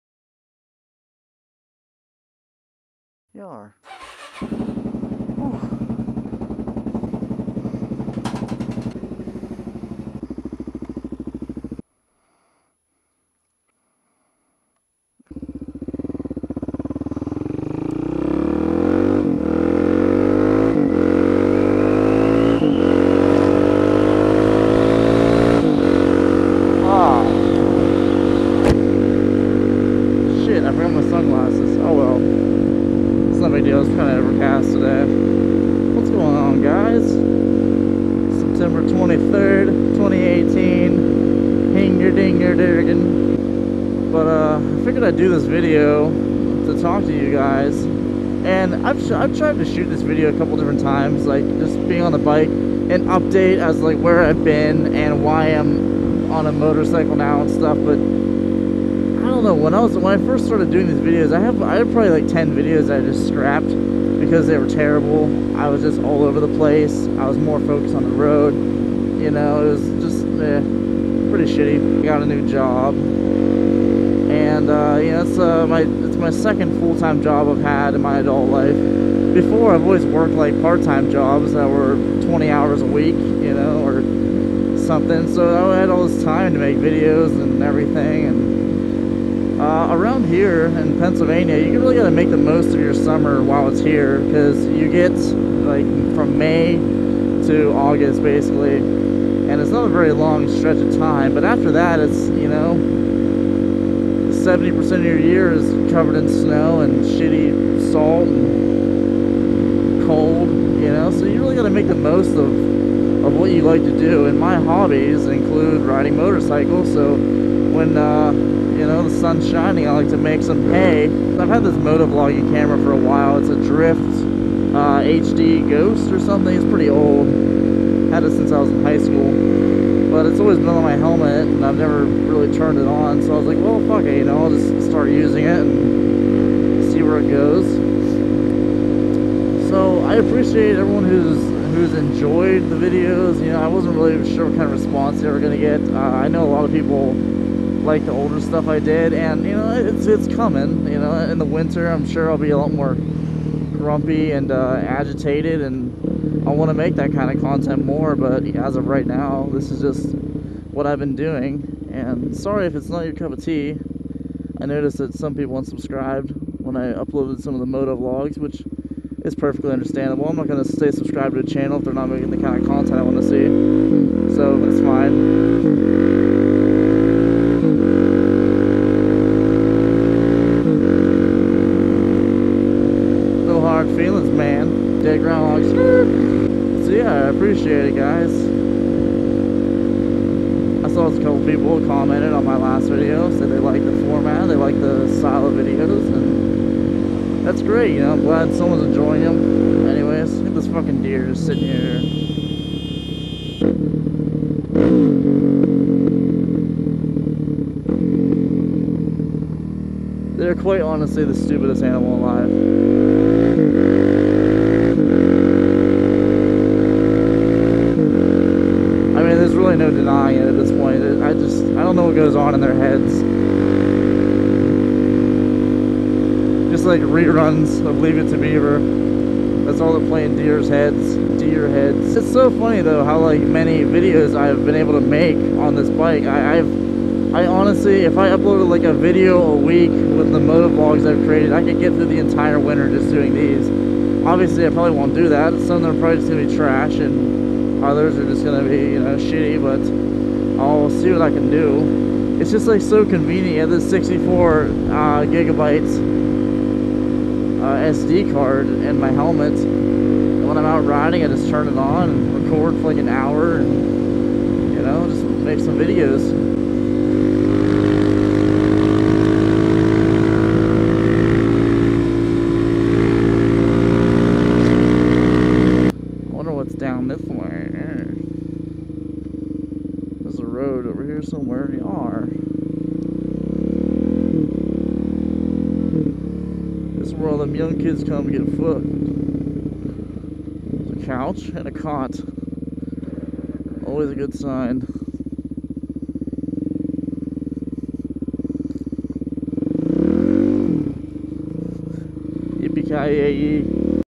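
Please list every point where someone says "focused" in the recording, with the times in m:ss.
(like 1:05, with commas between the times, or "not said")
1:07.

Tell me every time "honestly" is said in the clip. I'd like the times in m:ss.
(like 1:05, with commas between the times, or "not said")
3:30, 3:57.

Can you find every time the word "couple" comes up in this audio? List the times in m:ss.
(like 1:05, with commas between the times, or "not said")
0:50, 3:11.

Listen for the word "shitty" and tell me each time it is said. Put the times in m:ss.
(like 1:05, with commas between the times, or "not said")
1:11, 1:47, 4:09.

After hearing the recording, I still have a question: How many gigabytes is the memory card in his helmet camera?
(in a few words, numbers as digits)
64.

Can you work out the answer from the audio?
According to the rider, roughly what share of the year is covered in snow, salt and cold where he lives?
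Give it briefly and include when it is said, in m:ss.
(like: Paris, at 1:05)
70%, at 1:44.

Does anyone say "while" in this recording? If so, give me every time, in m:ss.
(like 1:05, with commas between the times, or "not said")
1:33, 2:02.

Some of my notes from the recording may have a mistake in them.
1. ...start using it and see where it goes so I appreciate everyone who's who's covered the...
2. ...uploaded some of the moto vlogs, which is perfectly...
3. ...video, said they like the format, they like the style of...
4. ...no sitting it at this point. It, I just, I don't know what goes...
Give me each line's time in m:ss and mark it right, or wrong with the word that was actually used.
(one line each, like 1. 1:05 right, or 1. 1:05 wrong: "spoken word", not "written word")
1. 2:14 wrong: "enjoyed", not "covered"
2. 2:46 right
3. 3:12 right
4. 3:39 wrong: "denying", not "sitting".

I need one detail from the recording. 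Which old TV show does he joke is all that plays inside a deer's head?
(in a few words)
Leave It to Beaver.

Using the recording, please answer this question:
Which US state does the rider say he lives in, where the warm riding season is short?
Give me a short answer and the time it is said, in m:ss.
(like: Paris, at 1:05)
Pennsylvania, at 1:30.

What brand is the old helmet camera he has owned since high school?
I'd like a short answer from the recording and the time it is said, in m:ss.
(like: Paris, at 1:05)
Drift, at 2:03.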